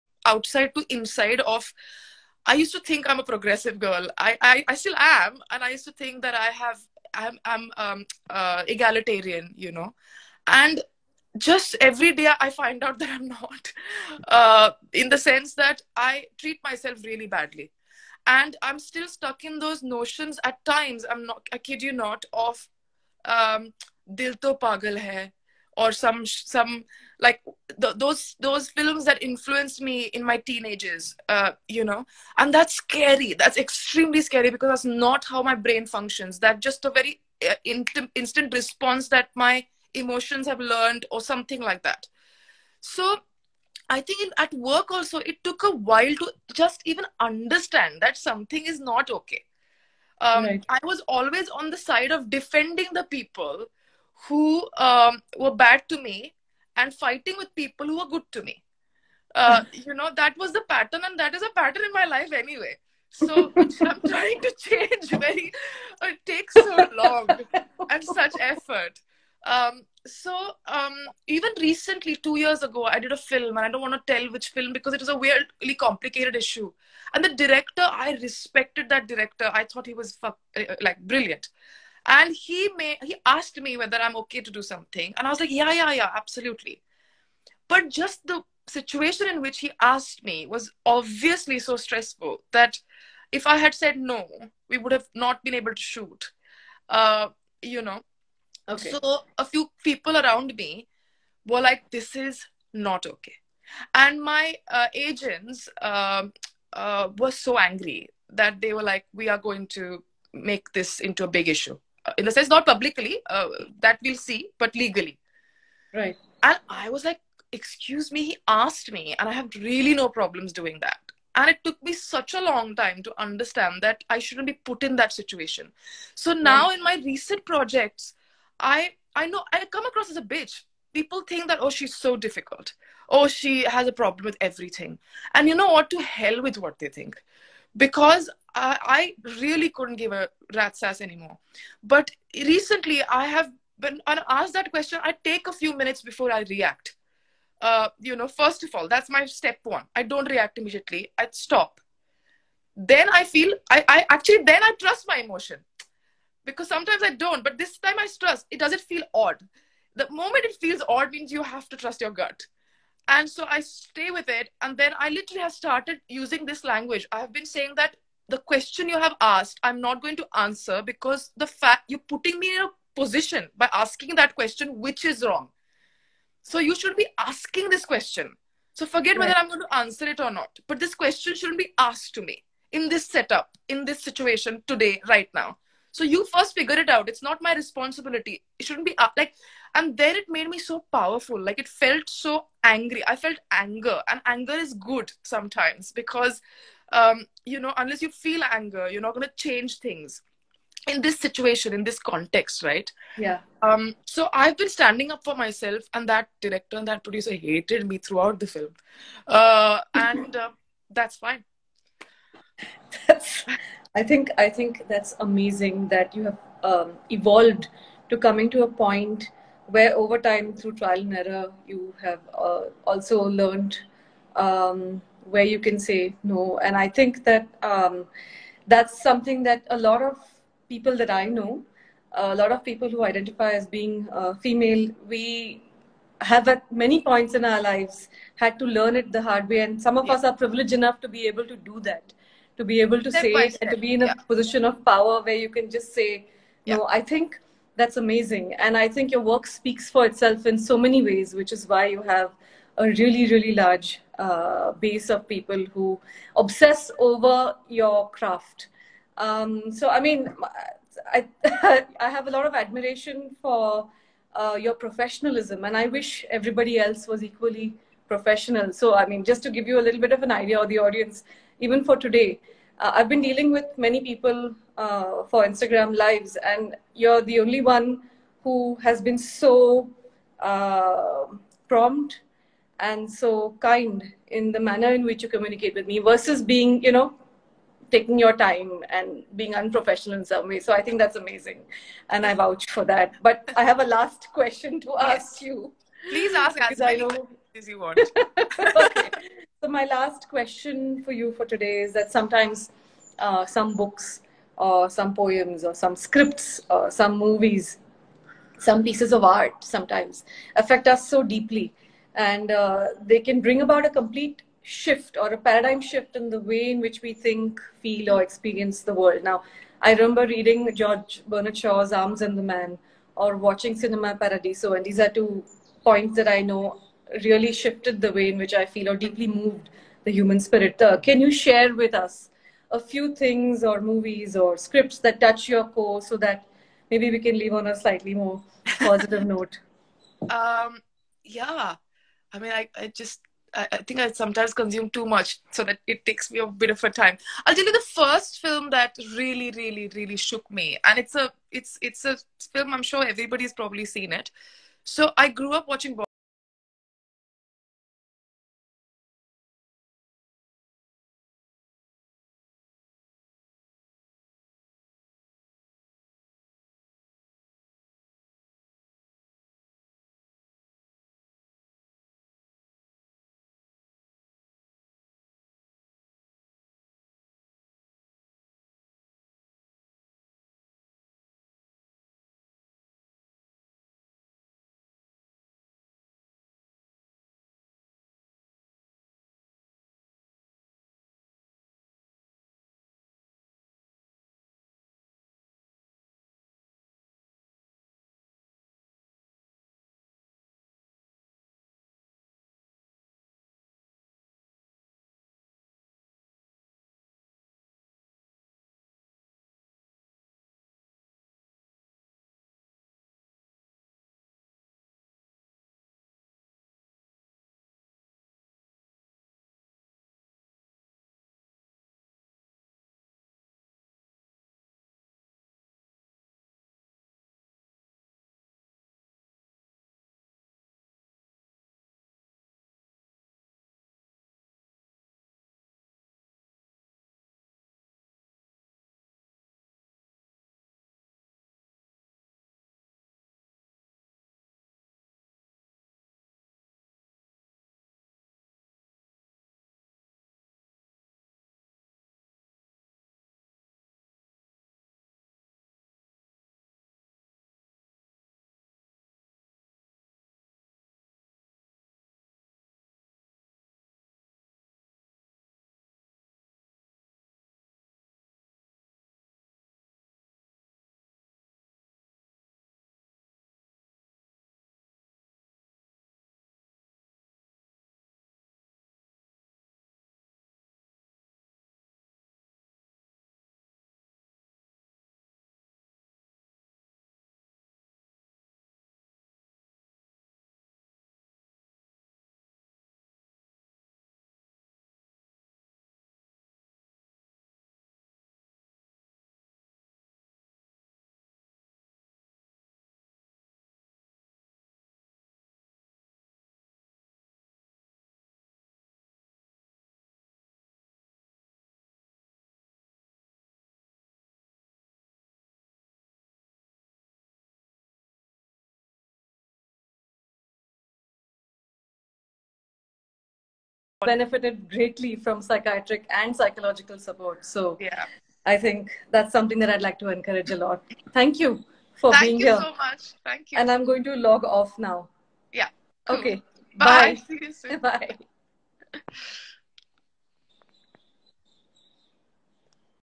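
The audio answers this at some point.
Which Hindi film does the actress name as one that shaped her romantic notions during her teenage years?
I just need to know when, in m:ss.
0:24.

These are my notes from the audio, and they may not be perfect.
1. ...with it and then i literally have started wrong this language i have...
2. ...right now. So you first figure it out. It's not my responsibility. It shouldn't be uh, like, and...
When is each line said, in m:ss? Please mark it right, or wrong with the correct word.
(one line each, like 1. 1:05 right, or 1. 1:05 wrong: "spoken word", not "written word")
1. 2:44 wrong: "using", not "wrong"
2. 3:05 right.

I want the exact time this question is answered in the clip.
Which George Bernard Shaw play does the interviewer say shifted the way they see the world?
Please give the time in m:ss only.
5:21.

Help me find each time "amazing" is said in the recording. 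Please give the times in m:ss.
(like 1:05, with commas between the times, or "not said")
3:35, 4:07, 4:51.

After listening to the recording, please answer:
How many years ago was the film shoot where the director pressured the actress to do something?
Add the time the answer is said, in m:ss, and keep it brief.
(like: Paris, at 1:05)
2, at 1:12.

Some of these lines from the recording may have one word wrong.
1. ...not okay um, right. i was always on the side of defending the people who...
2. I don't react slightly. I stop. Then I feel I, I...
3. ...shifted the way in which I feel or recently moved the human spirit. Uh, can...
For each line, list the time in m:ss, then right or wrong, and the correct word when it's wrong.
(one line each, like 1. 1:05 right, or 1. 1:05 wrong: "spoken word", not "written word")
1. 0:48 right
2. 2:29 wrong: "immediately", not "slightly"
3. 5:27 wrong: "deeply", not "recently".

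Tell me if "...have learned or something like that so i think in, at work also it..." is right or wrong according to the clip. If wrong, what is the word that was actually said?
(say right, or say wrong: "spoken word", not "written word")
right.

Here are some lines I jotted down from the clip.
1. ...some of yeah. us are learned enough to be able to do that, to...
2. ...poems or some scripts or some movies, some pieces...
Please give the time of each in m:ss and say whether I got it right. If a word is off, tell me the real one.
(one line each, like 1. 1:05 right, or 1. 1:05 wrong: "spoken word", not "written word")
1. 3:59 wrong: "privileged", not "learned"
2. 5:05 right.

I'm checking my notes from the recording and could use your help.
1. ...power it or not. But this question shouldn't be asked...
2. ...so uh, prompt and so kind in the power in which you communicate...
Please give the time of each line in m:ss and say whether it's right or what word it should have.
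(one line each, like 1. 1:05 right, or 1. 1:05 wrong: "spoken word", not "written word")
1. 2:59 wrong: "answer", not "power"
2. 4:39 wrong: "manner", not "power".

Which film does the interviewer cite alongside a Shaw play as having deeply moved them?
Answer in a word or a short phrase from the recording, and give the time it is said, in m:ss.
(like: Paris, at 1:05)
Cinema Paradiso, at 5:23.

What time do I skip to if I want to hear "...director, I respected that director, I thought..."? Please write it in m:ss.
1:17.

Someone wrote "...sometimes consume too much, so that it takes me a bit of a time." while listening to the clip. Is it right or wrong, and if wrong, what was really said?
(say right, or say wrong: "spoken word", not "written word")
right.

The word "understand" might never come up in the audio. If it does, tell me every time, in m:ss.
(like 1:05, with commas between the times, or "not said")
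0:47, 2:03.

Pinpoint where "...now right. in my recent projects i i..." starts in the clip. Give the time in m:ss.
2:06.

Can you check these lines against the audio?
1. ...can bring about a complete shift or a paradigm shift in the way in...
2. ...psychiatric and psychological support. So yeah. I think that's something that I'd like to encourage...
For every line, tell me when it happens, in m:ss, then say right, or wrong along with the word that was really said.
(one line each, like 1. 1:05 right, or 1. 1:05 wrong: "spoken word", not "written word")
1. 5:13 right
2. 8:45 right.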